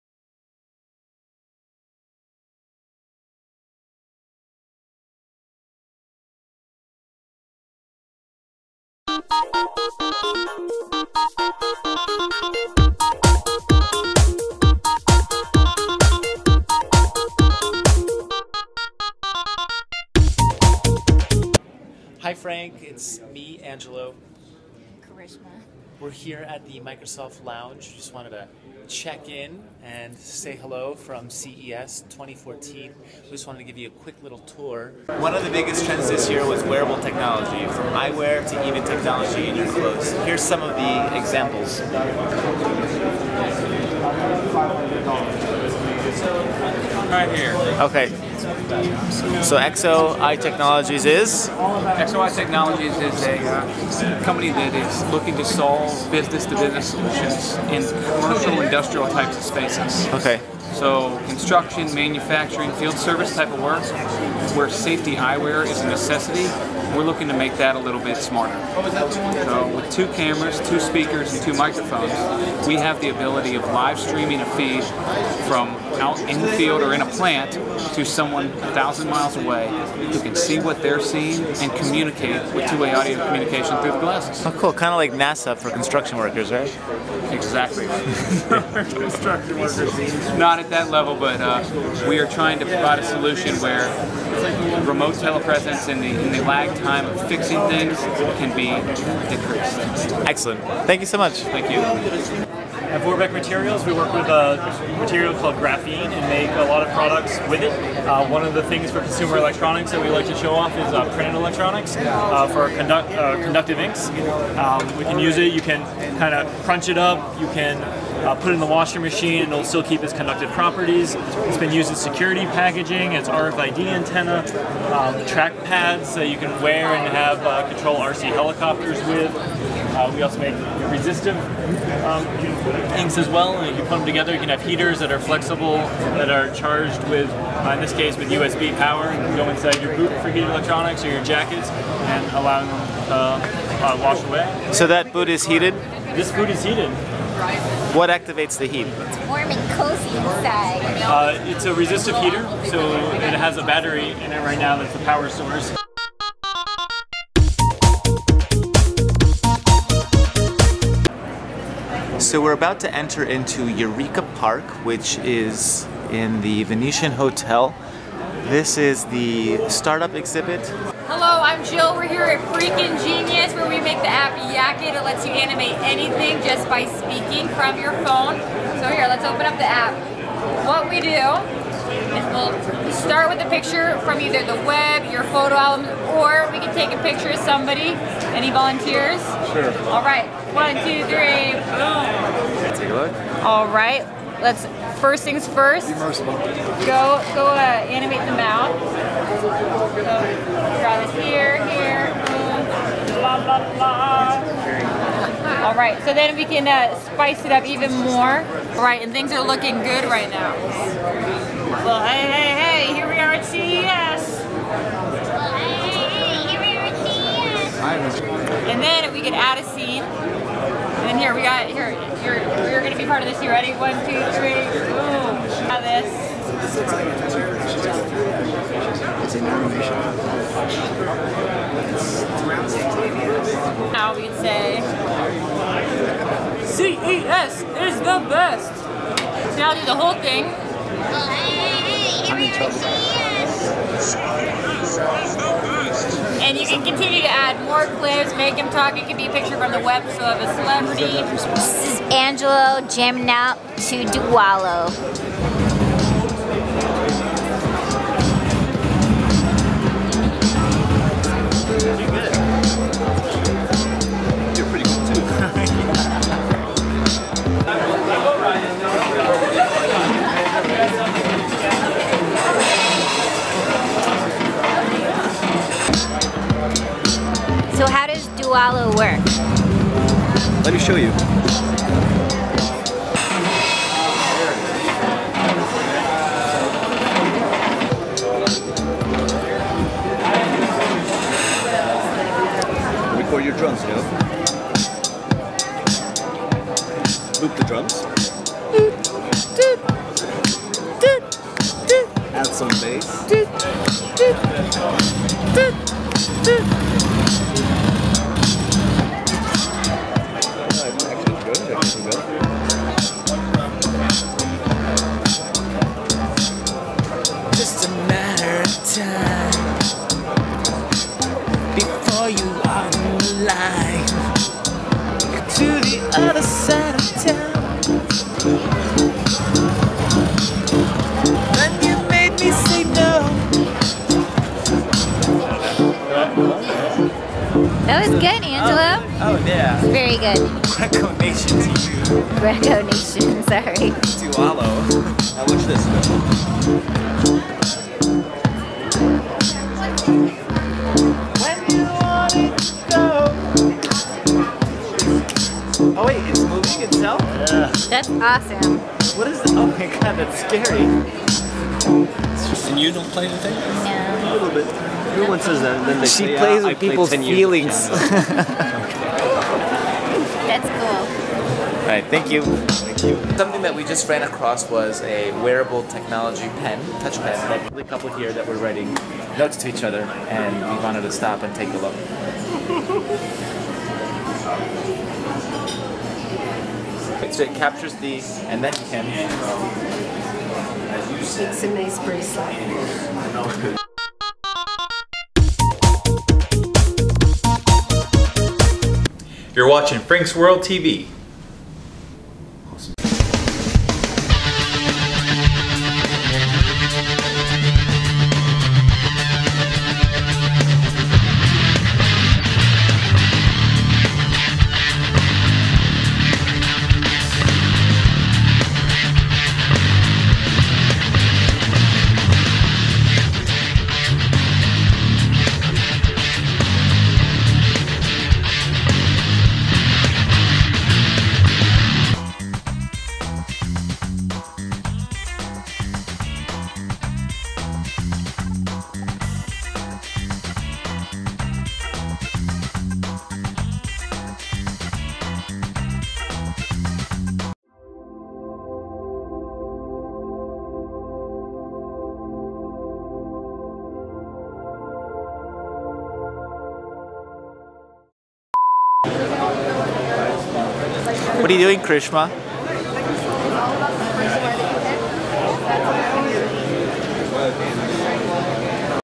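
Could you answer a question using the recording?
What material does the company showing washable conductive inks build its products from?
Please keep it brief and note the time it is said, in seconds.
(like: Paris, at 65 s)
graphene, at 105 s.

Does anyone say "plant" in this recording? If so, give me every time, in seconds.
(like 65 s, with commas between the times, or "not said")
77 s.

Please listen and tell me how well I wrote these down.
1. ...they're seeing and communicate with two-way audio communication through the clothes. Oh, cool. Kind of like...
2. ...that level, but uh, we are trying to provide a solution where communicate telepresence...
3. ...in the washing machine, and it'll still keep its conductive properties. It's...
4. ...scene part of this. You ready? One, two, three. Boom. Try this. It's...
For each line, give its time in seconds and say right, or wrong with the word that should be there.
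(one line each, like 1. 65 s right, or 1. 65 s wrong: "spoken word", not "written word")
1. 80 s wrong: "glasses", not "clothes"
2. 90 s wrong: "remote", not "communicate"
3. 118 s right
4. 219 s right.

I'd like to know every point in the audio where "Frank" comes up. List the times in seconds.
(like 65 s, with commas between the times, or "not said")
22 s, 399 s.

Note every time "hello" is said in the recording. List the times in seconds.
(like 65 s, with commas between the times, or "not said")
30 s, 171 s.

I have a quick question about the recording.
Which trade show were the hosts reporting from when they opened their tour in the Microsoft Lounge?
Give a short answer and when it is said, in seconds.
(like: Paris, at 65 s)
CES 2014, at 31 s.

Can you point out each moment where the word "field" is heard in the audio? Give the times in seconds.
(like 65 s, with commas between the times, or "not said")
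62 s, 76 s.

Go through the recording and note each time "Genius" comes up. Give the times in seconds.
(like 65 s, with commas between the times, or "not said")
173 s.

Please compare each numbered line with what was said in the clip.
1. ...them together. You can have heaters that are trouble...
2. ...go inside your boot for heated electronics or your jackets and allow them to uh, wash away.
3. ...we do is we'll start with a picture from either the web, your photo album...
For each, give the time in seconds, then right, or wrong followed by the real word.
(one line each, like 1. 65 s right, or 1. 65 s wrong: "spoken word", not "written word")
1. 133 s wrong: "flexible", not "trouble"
2. 139 s right
3. 180 s right.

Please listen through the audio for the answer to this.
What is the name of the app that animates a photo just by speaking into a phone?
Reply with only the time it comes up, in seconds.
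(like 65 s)
174 s.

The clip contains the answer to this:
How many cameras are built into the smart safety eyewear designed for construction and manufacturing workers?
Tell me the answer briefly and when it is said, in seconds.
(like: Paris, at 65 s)
2, at 69 s.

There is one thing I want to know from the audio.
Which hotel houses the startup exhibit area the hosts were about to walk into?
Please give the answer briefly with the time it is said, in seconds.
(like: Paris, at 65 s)
Venetian Hotel, at 166 s.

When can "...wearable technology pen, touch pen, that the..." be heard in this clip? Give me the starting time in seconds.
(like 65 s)
375 s.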